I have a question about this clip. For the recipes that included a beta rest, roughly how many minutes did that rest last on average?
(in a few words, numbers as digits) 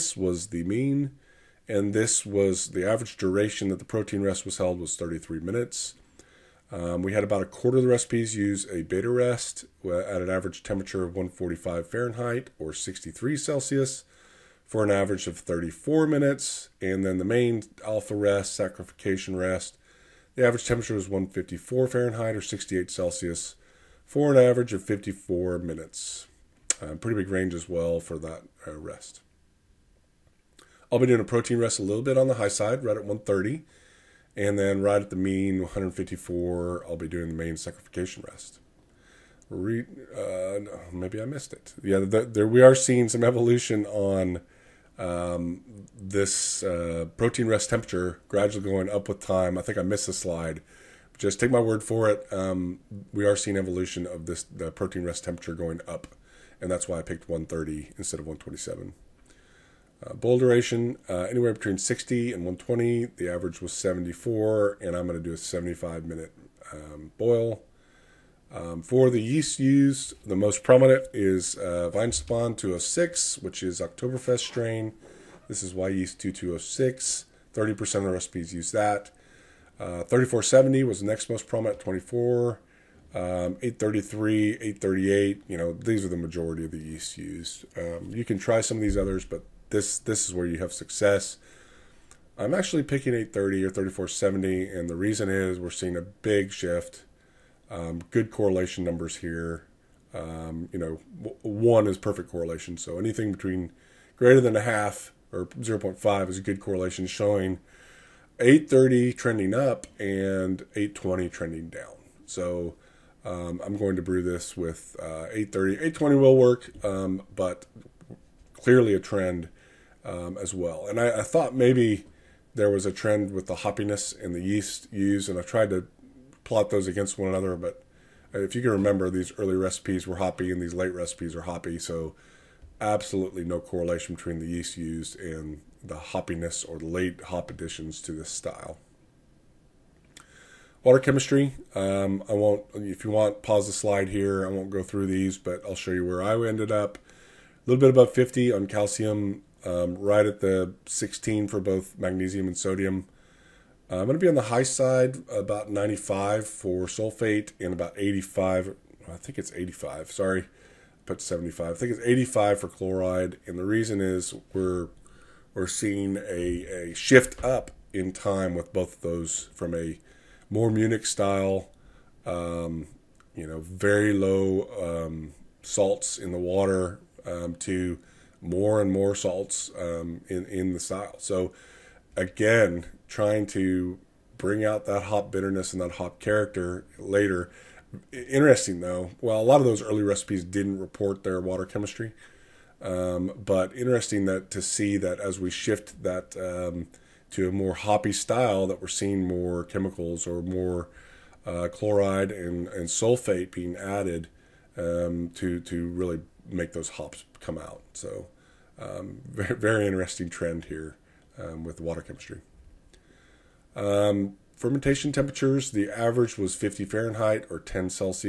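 34 minutes.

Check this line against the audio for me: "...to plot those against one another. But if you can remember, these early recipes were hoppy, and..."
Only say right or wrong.
right.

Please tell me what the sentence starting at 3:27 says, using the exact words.
So, um, very, very, interesting trend here um, with water chemistry.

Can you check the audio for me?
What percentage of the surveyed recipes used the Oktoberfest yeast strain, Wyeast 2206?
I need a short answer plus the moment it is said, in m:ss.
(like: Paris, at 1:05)
30%, at 1:17.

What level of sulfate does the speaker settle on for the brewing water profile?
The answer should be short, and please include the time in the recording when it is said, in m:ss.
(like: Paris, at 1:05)
95, at 2:35.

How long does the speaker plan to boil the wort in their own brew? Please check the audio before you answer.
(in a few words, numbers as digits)
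75 minutes.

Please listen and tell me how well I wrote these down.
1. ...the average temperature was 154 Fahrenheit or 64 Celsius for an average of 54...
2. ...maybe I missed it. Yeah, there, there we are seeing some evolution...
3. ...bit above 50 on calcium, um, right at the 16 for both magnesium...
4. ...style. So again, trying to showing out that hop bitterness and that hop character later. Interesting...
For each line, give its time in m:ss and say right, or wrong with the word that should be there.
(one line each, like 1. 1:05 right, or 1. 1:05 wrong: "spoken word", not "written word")
1. 0:20 wrong: "68", not "64"
2. 0:40 right
3. 2:27 right
4. 3:00 wrong: "bring", not "showing".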